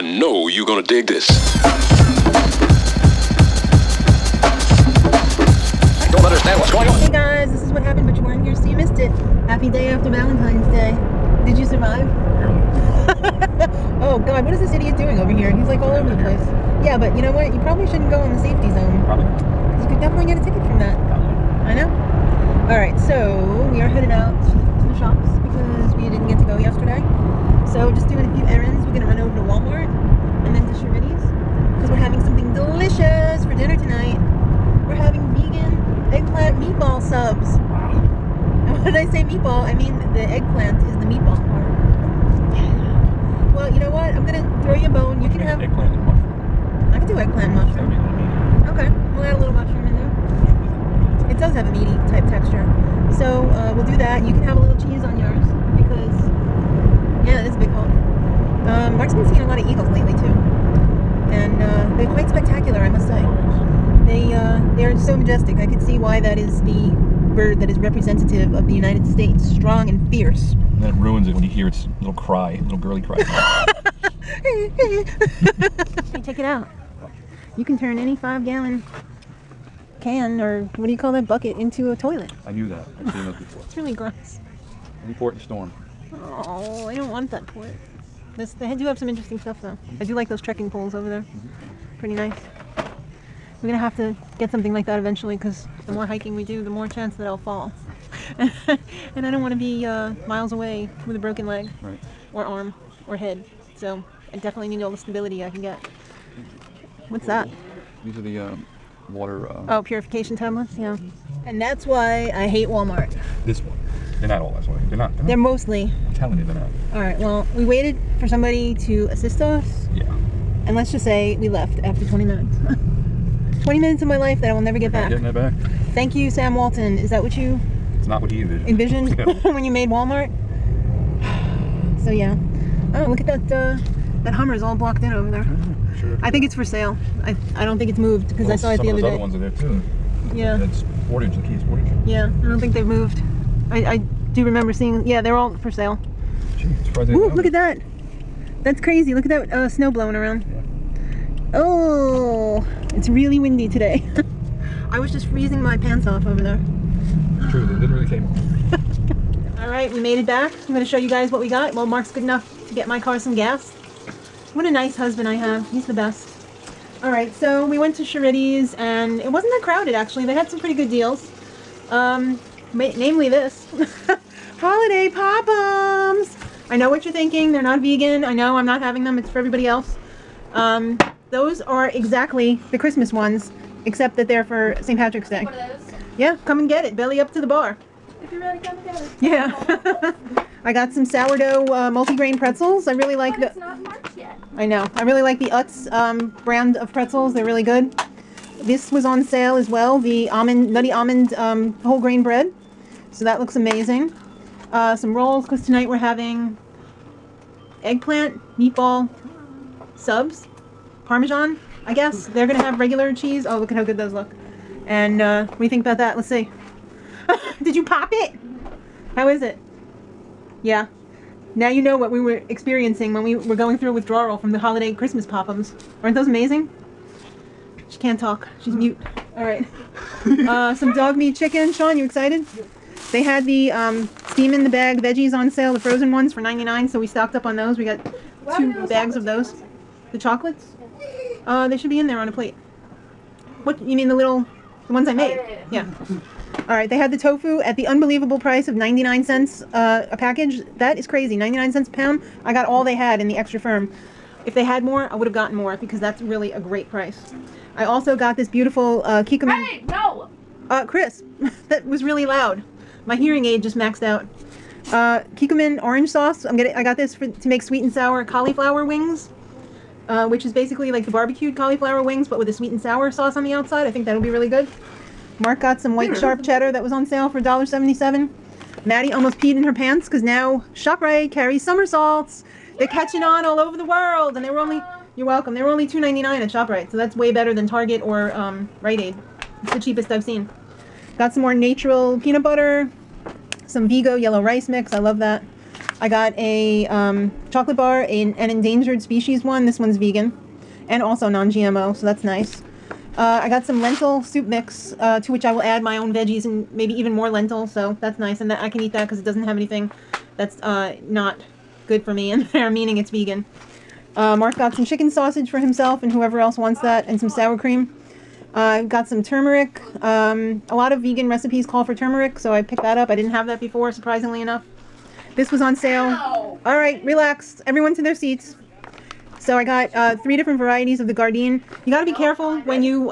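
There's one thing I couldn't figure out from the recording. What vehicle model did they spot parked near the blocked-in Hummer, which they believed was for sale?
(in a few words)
Kia Sportage.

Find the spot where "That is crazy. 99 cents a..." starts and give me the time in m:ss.
4:10.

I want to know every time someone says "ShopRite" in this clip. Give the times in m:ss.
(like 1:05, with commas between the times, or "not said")
4:40, 4:46.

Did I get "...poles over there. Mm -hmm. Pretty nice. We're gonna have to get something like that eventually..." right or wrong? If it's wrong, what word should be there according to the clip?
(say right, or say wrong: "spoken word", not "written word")
right.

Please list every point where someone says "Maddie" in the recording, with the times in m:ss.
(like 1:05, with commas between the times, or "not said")
4:38.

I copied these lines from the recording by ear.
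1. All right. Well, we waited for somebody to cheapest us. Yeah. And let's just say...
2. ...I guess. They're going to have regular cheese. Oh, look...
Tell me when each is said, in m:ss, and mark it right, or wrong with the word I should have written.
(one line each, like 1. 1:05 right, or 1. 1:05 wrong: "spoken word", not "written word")
1. 1:56 wrong: "assist", not "cheapest"
2. 3:31 right.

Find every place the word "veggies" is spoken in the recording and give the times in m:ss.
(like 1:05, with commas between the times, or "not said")
3:54, 5:06.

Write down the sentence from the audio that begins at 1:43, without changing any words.
So I definitely need all the stability I can get.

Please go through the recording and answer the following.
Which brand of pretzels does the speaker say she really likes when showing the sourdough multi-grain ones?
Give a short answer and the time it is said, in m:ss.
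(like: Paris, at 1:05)
Utz, at 3:15.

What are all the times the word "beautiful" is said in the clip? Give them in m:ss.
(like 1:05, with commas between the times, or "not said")
4:18.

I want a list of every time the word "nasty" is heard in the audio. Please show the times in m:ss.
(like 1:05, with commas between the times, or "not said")
not said.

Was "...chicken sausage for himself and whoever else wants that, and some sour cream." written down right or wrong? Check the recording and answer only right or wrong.
right.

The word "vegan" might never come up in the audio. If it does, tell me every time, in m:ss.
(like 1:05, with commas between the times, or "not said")
2:57, 4:59, 5:13, 5:20.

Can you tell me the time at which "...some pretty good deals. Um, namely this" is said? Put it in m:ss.
2:50.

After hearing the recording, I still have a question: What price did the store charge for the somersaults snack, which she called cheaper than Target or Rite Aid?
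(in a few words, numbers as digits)
$2.99.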